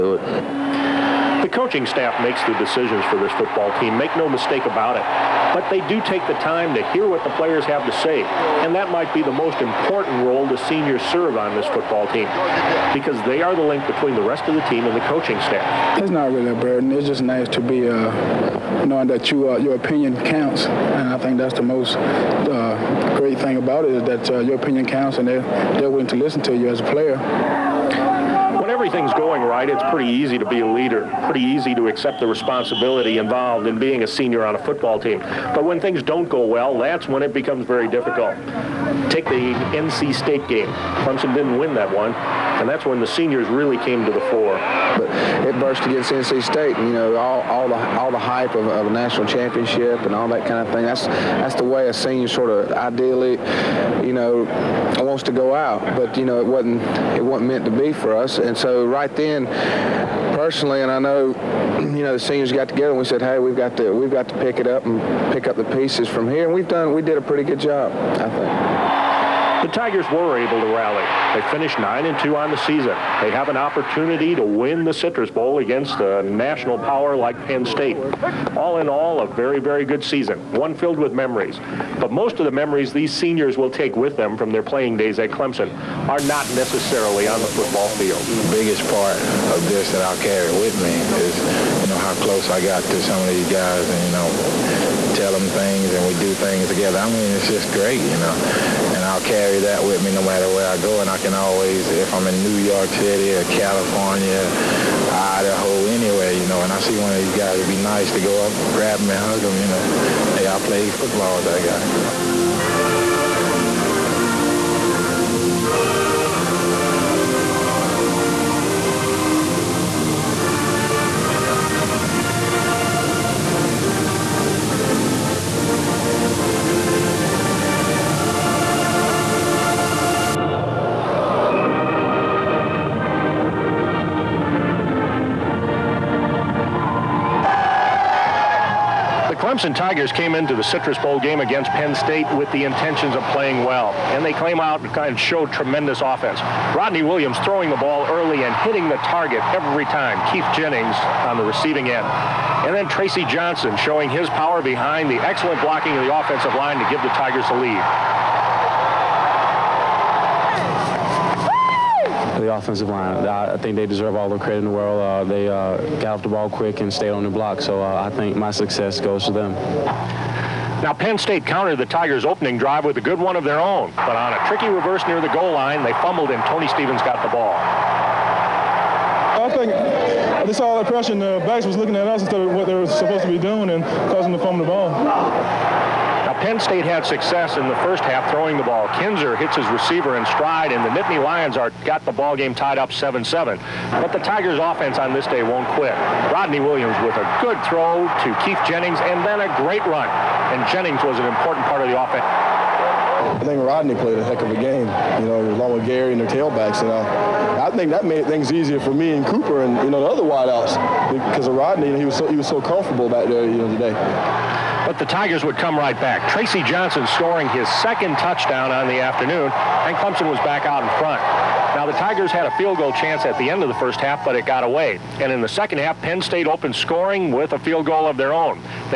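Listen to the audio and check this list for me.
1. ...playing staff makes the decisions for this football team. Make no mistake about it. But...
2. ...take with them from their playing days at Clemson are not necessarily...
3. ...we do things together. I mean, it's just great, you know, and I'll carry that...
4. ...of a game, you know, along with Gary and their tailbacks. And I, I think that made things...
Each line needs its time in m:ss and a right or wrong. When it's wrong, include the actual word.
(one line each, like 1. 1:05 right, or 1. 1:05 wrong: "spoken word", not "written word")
1. 0:01 wrong: "coaching", not "playing"
2. 1:23 right
3. 1:36 right
4. 3:24 right.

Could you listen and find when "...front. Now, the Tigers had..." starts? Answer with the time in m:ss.
3:40.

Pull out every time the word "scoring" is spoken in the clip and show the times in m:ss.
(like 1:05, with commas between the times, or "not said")
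3:37, 3:46.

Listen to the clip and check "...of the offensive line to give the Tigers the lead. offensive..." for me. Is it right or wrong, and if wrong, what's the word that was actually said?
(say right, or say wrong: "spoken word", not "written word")
right.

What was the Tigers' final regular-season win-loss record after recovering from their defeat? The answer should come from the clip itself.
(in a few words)
9-2.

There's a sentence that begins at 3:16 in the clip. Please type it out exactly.
Rodney Williams with a good throw to Keith Jennings, and then a great run.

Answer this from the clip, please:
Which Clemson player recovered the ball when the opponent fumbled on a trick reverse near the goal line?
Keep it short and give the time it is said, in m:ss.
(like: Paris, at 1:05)
Tony Stevens, at 2:56.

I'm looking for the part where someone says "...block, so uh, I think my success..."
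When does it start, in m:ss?
2:47.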